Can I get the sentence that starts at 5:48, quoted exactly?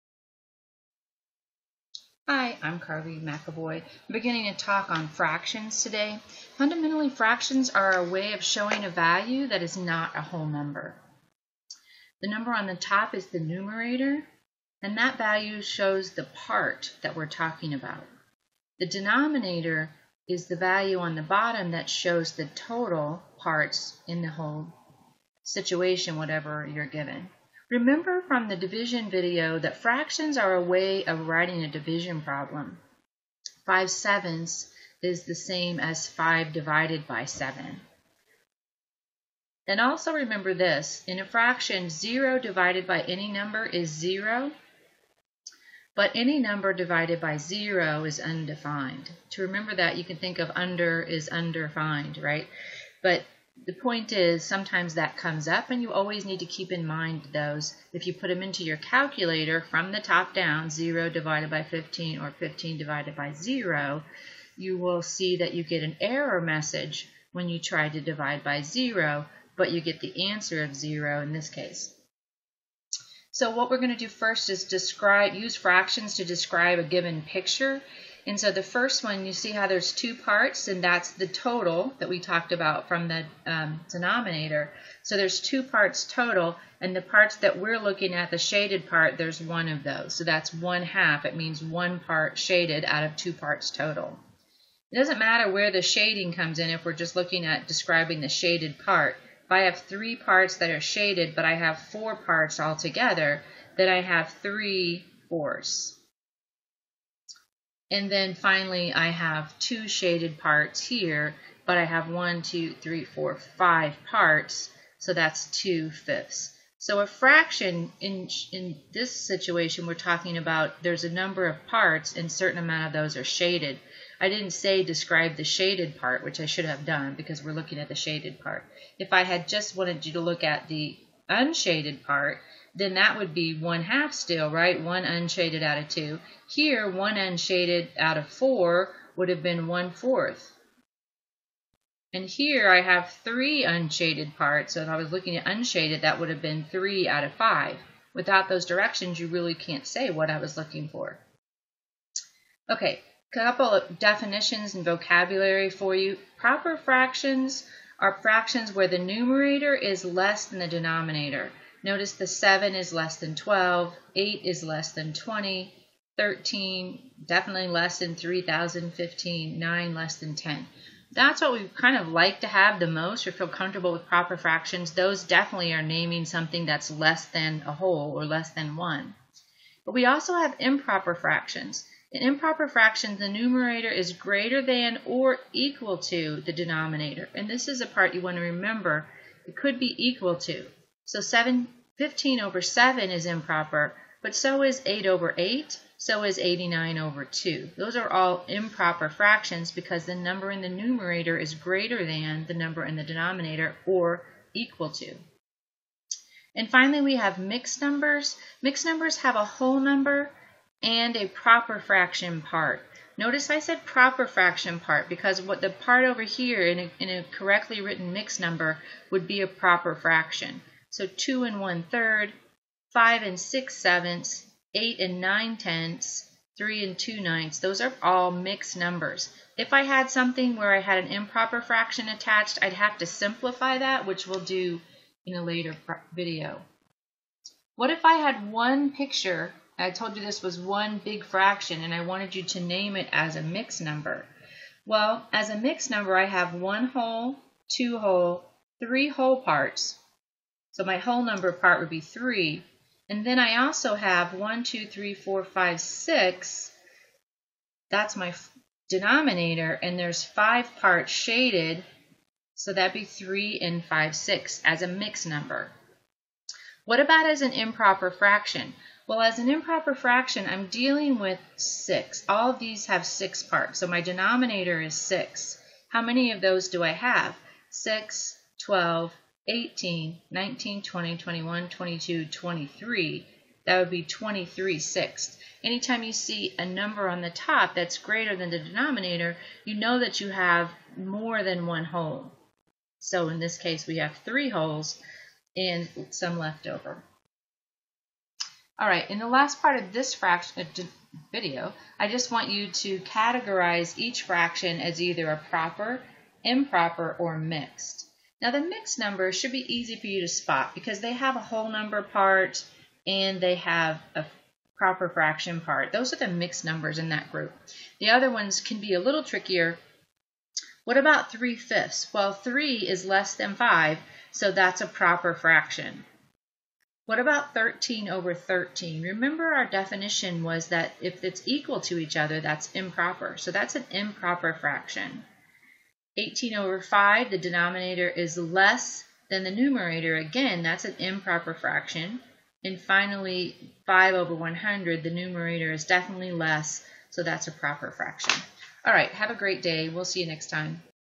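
All right, have a great day.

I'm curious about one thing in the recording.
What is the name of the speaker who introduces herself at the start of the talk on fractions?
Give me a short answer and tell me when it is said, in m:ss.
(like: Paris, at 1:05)
Carly McAvoy, at 0:02.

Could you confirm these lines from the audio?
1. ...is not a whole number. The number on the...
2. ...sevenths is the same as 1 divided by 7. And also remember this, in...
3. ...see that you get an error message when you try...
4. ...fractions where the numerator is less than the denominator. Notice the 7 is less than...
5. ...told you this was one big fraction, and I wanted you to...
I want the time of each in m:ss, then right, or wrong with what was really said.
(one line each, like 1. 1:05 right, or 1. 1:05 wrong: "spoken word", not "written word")
1. 0:09 right
2. 0:33 wrong: "5", not "1"
3. 1:05 right
4. 2:38 right
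5. 3:59 right.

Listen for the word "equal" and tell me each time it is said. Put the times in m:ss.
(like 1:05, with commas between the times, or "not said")
3:05, 3:09, 3:24, 5:31.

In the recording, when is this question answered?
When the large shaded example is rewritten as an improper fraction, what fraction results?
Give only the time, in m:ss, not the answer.
4:44.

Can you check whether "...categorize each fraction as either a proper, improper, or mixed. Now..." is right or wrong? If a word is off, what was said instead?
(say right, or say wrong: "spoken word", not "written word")
right.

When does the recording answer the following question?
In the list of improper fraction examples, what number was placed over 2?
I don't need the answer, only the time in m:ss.
3:16.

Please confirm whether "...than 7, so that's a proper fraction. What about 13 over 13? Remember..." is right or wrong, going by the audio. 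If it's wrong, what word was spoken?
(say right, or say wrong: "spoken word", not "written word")
wrong: "5", not "7".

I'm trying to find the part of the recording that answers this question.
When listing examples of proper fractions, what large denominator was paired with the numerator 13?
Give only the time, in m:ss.
2:48.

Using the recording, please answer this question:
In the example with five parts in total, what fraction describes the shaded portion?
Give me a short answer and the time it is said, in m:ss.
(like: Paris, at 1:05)
two fifths, at 1:55.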